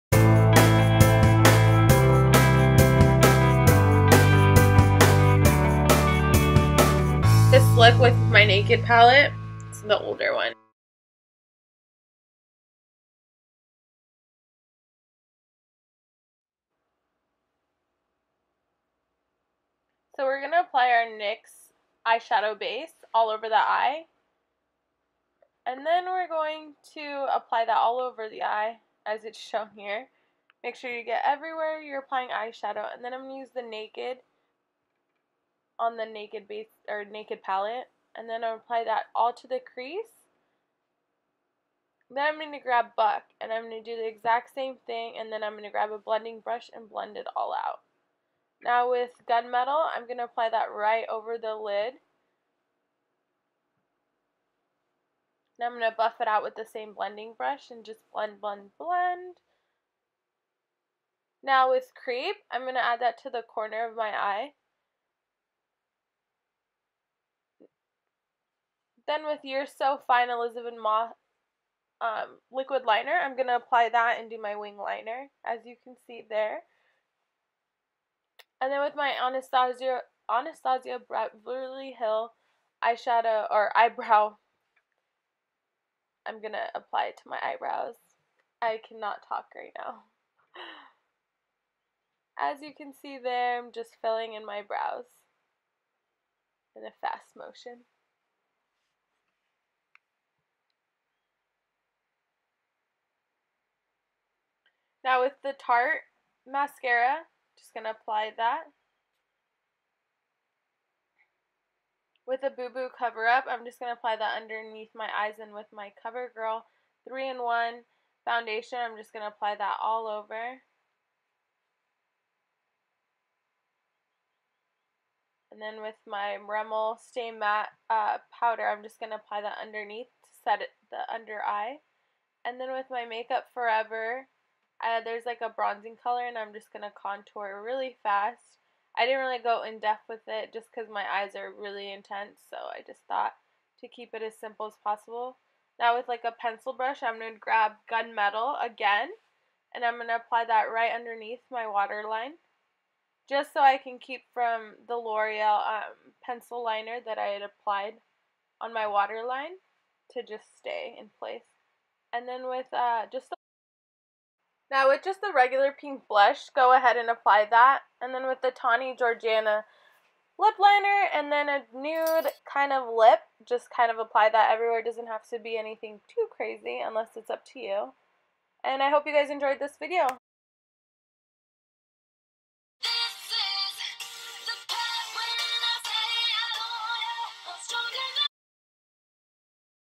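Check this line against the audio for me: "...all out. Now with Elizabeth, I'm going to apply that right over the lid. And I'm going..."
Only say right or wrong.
wrong.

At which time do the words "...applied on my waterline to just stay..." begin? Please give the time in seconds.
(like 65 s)
157 s.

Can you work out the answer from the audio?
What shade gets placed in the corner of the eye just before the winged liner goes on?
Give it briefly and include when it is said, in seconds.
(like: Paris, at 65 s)
Creep, at 61 s.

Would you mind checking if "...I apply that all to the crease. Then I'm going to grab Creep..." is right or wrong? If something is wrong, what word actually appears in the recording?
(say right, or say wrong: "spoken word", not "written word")
wrong: "Buck", not "Creep".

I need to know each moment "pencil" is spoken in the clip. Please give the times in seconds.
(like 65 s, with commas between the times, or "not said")
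146 s, 156 s.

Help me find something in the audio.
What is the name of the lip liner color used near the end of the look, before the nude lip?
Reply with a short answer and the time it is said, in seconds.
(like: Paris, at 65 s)
Tawny, at 168 s.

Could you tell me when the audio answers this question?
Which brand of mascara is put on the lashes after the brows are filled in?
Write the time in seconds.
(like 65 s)
105 s.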